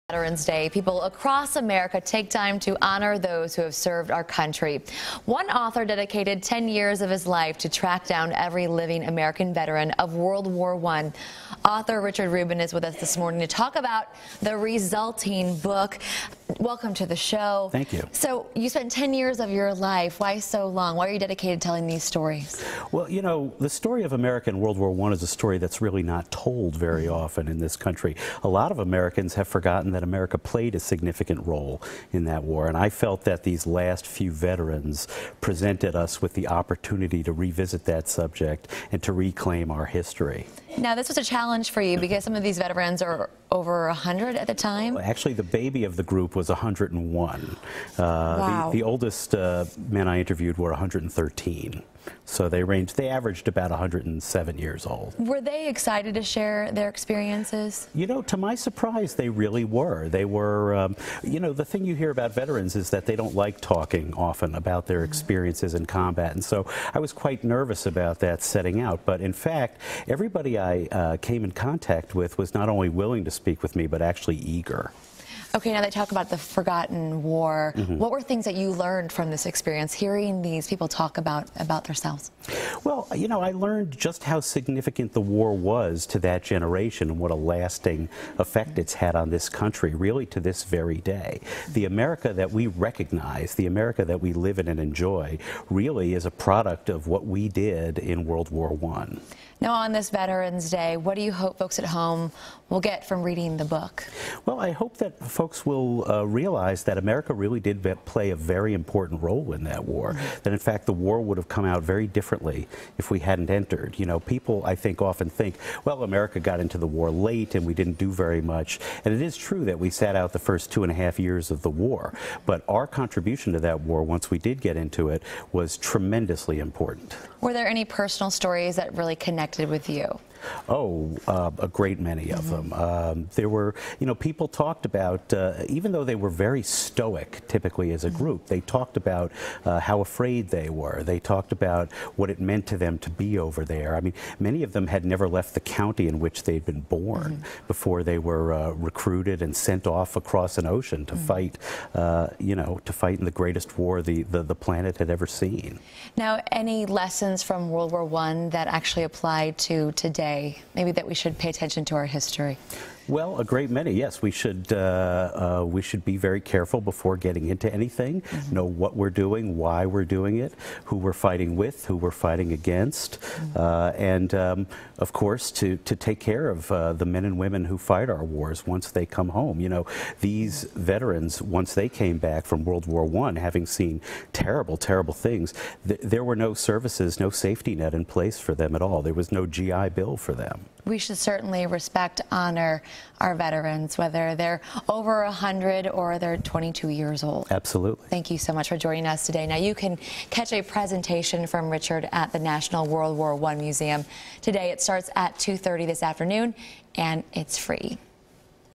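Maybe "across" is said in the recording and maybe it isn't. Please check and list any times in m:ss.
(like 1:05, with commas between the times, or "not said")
0:01, 2:30.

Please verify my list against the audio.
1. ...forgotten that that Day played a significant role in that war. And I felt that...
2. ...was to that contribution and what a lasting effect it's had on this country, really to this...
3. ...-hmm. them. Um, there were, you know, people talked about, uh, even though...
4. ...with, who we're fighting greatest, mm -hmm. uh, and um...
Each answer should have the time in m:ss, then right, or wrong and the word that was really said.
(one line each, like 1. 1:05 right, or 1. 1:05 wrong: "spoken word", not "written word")
1. 0:29 wrong: "America", not "Day"
2. 1:25 wrong: "generation", not "contribution"
3. 2:12 right
4. 2:51 wrong: "against", not "greatest".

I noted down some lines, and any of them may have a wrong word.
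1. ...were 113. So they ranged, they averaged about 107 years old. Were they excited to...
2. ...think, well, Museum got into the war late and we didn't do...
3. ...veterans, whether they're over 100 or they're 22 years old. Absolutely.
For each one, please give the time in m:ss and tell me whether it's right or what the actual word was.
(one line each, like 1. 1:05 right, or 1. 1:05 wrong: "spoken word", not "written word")
1. 0:50 right
2. 1:55 wrong: "America", not "Museum"
3. 3:13 right.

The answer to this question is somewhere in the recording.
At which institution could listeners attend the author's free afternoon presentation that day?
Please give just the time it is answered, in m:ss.
3:22.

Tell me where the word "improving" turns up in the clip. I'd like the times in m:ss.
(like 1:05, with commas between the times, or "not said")
not said.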